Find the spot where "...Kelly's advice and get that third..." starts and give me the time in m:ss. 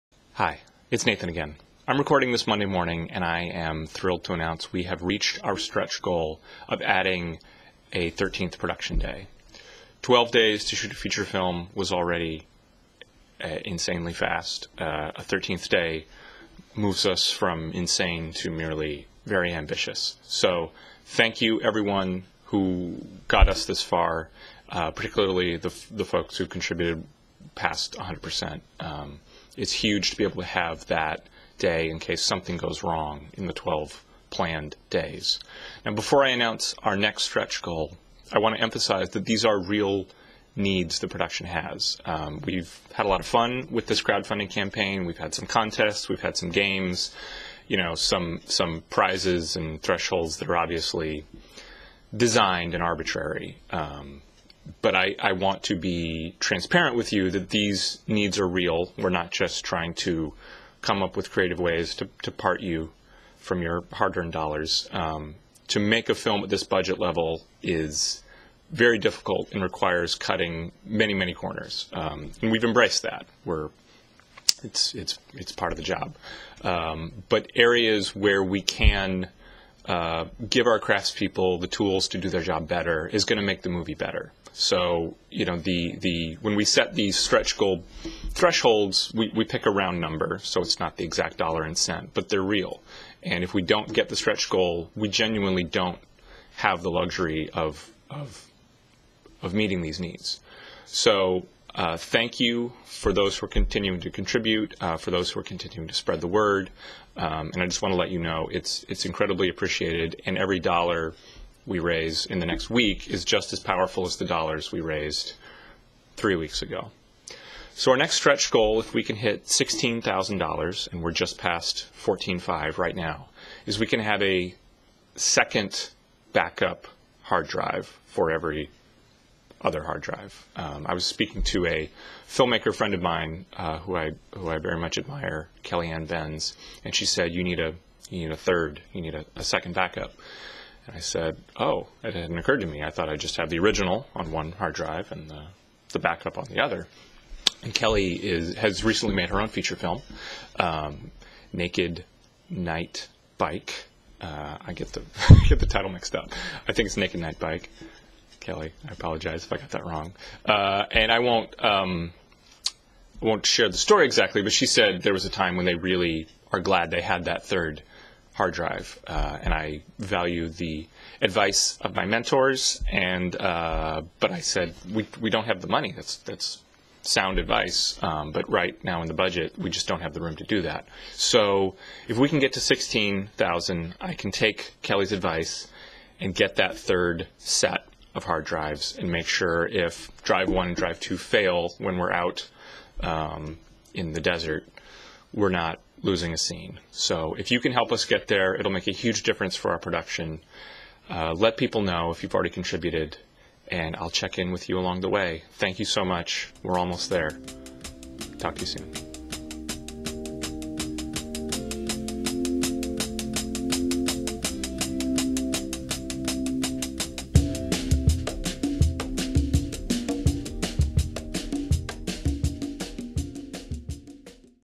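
3:04.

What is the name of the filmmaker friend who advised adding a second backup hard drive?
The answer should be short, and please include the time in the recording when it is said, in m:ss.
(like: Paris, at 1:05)
Kellyanne Benz, at 2:15.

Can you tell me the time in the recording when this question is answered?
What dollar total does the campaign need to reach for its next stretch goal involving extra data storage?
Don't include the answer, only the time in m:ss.
1:59.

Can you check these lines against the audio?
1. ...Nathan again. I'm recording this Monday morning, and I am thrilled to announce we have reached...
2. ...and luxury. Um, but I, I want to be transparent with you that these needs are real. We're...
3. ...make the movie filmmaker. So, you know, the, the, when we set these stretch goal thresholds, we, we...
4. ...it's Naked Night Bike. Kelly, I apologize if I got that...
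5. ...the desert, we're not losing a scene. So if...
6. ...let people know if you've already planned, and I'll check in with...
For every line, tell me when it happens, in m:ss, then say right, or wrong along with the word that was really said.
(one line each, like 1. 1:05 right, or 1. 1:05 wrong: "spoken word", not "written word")
1. 0:01 right
2. 0:52 wrong: "arbitrary", not "luxury"
3. 1:23 wrong: "better", not "filmmaker"
4. 2:36 right
5. 3:14 right
6. 3:21 wrong: "contributed", not "planned".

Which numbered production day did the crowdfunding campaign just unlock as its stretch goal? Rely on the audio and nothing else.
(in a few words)
13th.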